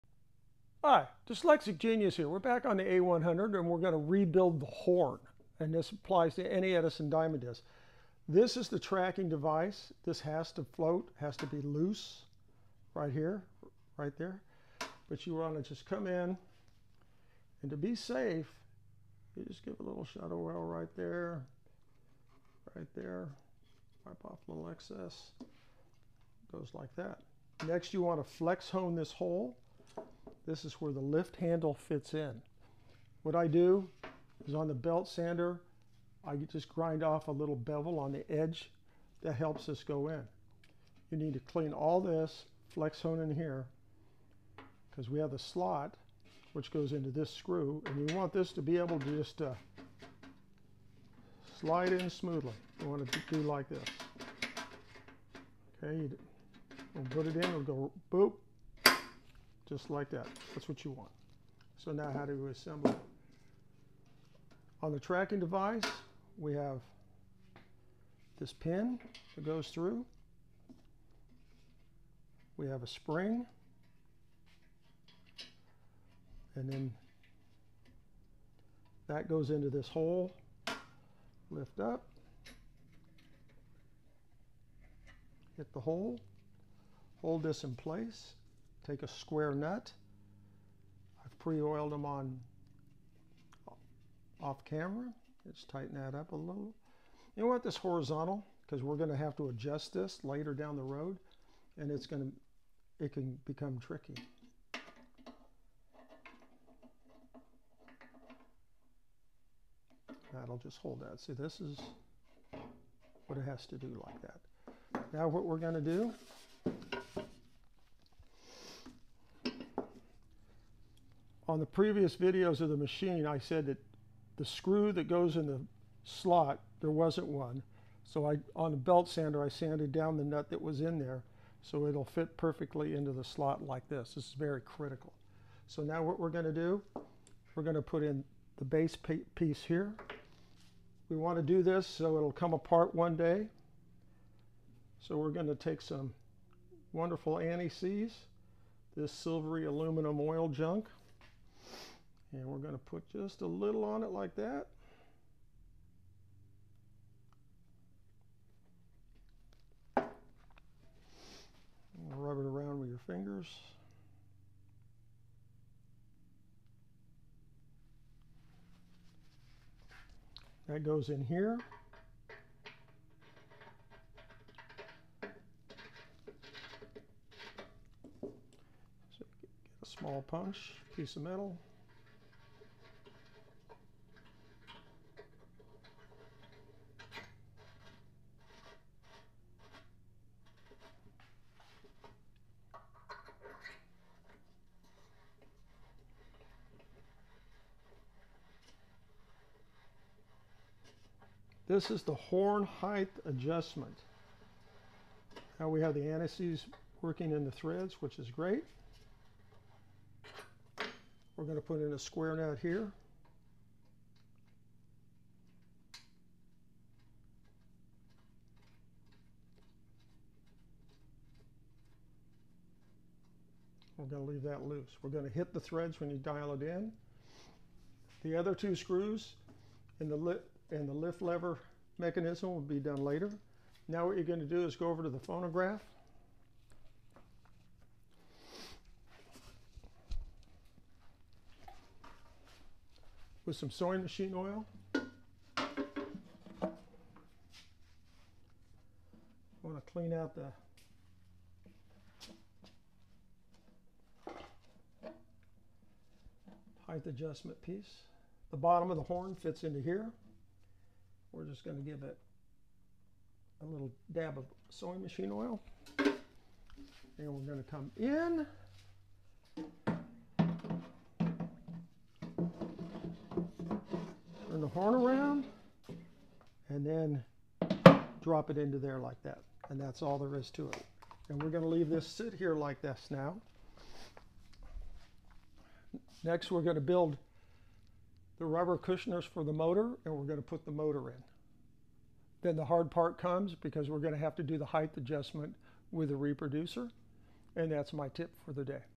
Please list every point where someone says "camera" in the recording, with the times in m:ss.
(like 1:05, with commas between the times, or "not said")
1:34.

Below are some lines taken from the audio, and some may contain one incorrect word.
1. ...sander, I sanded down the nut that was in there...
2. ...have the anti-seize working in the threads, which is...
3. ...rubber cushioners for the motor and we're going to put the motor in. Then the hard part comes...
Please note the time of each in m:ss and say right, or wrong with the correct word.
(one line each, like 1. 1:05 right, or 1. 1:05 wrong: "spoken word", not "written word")
1. 2:09 right
2. 3:25 right
3. 4:48 right.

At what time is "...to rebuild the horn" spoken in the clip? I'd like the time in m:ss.
0:03.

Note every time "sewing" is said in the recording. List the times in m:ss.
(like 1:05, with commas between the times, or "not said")
4:03, 4:24.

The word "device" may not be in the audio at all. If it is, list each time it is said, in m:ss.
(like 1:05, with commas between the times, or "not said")
0:09, 1:05.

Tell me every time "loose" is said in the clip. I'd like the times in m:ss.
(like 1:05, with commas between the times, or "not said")
0:11, 3:44.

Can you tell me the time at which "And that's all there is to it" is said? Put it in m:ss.
4:39.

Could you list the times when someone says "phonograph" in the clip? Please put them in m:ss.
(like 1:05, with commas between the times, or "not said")
3:55.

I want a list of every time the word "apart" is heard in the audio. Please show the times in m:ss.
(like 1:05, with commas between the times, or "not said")
2:22.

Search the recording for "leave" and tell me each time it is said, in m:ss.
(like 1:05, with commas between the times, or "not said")
3:44, 4:41.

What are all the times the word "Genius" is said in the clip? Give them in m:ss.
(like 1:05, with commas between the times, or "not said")
0:01.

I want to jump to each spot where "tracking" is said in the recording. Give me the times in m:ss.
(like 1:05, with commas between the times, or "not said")
0:08, 1:04.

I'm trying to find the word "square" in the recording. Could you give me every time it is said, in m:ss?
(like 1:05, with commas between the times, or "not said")
1:29, 3:31.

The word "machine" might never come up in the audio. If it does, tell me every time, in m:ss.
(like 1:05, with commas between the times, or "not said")
2:02, 4:04, 4:25.